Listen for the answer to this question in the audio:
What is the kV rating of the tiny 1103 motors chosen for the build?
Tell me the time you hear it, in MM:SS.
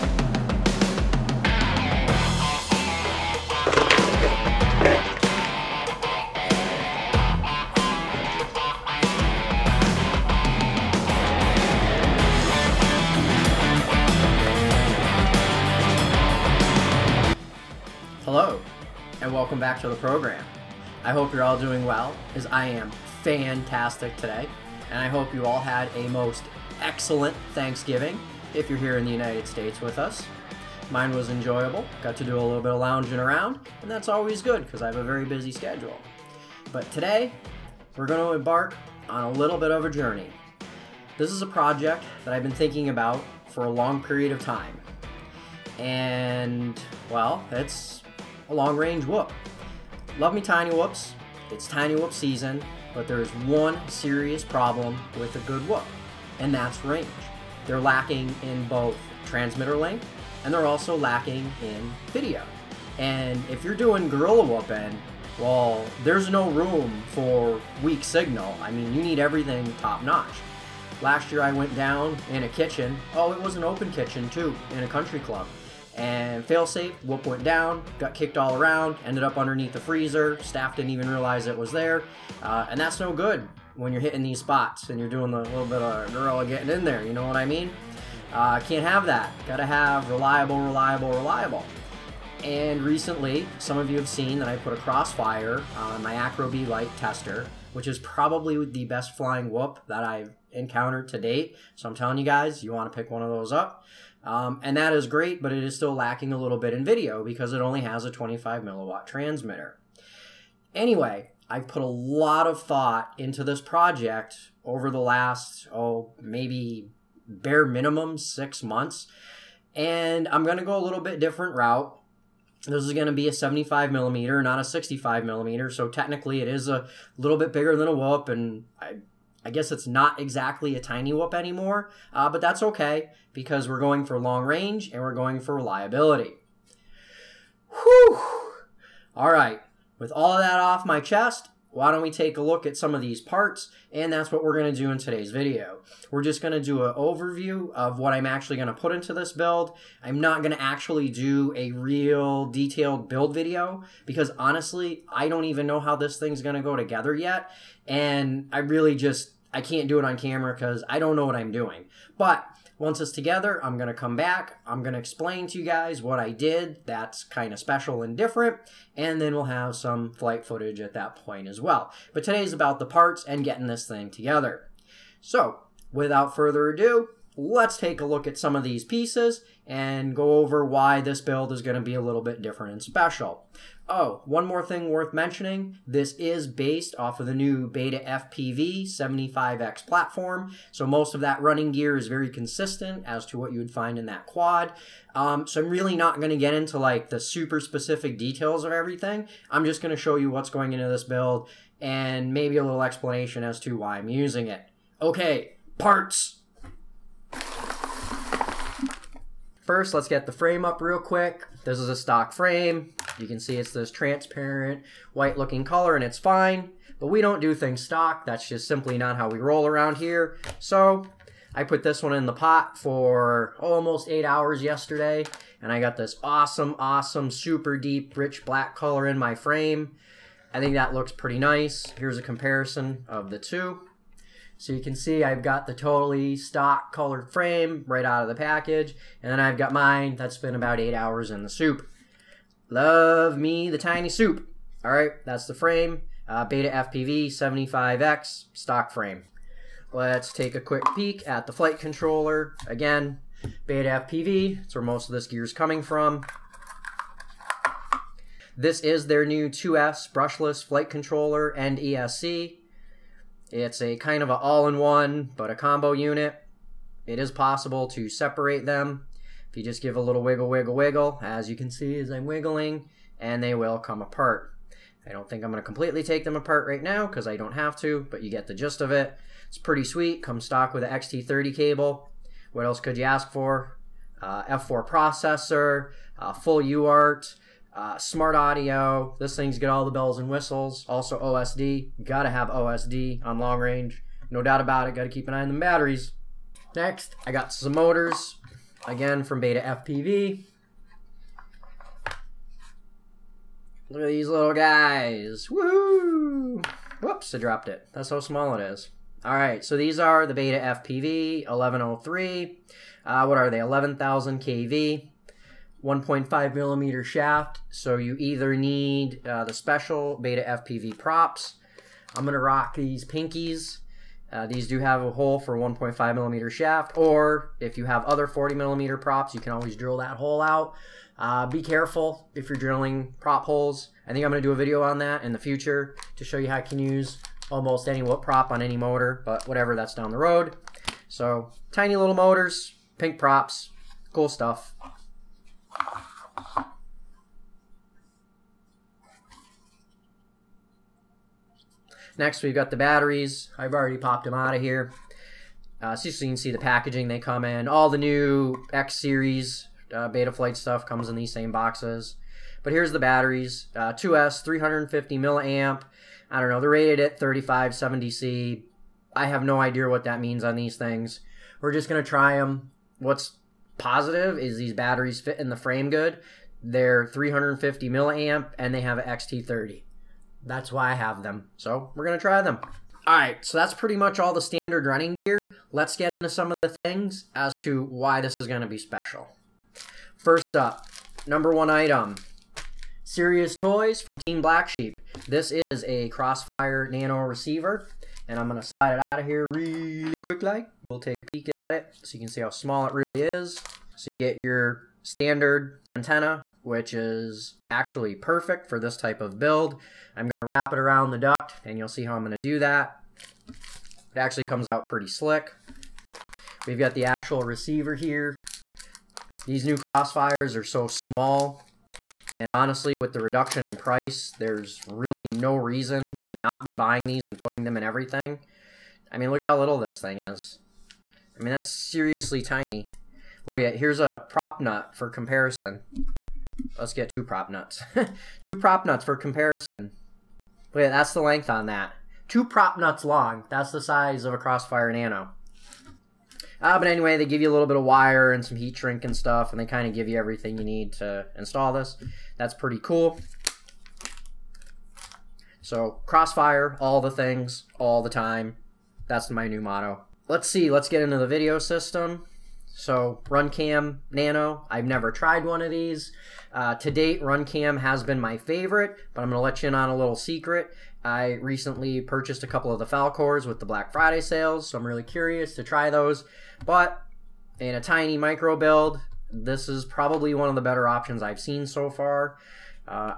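05:13.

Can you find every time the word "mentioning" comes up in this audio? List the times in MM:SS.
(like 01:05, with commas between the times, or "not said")
03:05.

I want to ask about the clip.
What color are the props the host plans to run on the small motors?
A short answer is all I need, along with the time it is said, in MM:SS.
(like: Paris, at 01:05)
Pink, at 05:23.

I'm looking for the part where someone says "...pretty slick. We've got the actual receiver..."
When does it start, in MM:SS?
06:54.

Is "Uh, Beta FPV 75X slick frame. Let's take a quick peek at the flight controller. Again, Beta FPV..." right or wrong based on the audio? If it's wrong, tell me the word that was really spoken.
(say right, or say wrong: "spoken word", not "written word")
wrong: "stock", not "slick".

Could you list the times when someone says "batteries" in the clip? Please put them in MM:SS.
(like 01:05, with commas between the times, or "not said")
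04:55, 05:52, 06:02, 06:14.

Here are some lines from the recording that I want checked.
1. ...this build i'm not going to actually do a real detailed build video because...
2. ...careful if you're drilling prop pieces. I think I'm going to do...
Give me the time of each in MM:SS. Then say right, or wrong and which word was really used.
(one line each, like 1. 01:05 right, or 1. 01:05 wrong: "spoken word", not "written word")
1. 02:29 right
2. 05:31 wrong: "holes", not "pieces".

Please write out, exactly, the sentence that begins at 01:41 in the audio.
So I'm telling you guys, you want to pick one of those up.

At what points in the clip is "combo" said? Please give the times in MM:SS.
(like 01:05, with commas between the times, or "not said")
04:25.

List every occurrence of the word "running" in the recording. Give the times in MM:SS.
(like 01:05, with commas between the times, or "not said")
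03:11, 06:24.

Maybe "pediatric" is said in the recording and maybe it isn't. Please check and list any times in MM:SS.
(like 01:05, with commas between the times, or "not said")
not said.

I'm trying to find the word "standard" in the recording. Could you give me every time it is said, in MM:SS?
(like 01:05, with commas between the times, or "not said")
06:24, 06:45.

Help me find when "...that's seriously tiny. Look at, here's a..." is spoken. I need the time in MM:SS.
07:11.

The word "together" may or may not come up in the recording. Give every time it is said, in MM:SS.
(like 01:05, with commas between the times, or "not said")
02:36, 02:43, 02:54.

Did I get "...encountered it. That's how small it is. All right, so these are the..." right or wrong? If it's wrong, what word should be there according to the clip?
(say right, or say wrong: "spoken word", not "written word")
wrong: "dropped", not "encountered".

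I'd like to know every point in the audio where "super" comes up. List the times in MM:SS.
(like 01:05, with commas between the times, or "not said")
03:17, 03:47.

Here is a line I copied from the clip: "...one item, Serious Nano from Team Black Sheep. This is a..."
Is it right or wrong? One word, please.
wrong.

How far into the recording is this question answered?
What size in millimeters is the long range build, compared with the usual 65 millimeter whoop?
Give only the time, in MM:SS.
02:03.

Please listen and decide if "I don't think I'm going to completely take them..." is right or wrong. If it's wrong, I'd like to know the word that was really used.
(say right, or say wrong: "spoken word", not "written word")
right.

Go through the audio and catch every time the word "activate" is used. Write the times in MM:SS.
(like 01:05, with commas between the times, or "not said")
not said.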